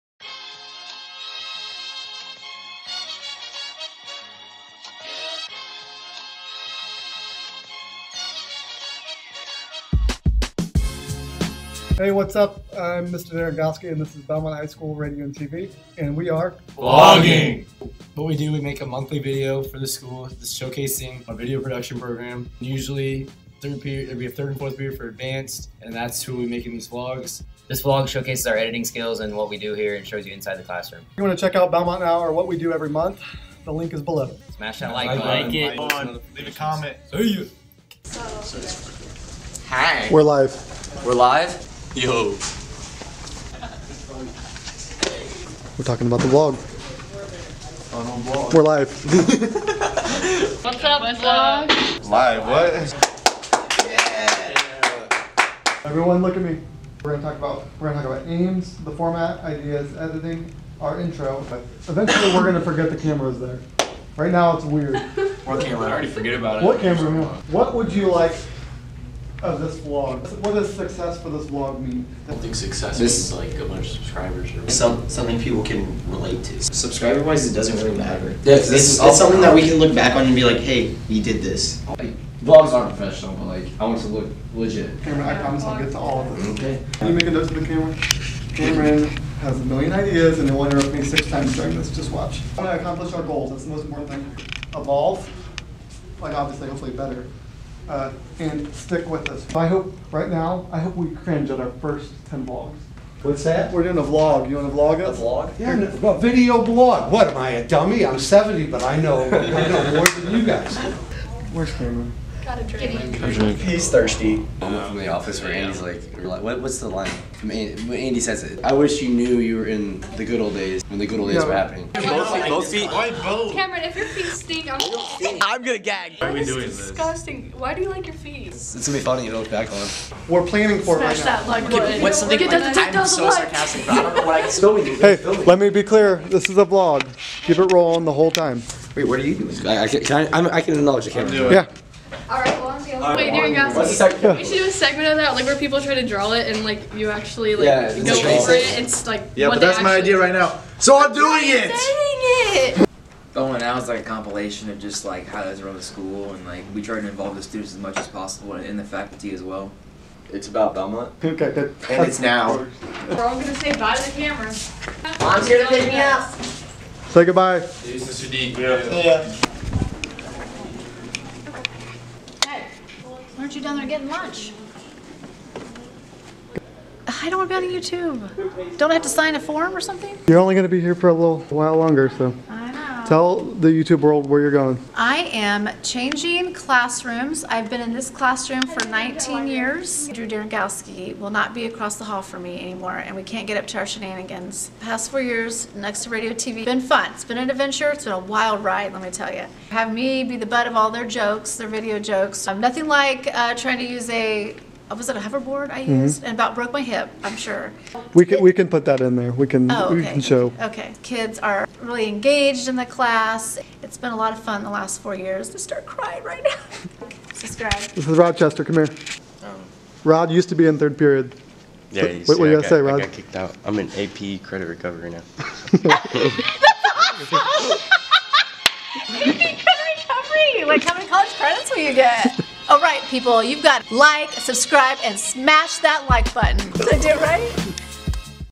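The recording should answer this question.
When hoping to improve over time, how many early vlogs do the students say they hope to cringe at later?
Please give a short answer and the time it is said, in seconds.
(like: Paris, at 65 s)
10, at 102 s.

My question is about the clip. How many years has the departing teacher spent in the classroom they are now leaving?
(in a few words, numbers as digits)
19.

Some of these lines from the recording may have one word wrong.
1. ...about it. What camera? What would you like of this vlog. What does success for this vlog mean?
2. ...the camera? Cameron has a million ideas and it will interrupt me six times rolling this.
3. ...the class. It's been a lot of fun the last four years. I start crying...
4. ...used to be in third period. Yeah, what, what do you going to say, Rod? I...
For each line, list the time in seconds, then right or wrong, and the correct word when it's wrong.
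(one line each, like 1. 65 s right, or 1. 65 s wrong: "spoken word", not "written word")
1. 66 s right
2. 87 s wrong: "during", not "rolling"
3. 212 s right
4. 220 s right.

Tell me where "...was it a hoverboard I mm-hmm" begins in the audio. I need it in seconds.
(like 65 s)
204 s.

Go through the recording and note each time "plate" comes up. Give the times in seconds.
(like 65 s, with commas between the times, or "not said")
not said.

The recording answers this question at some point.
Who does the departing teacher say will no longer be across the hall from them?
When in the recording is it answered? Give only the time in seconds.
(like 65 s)
190 s.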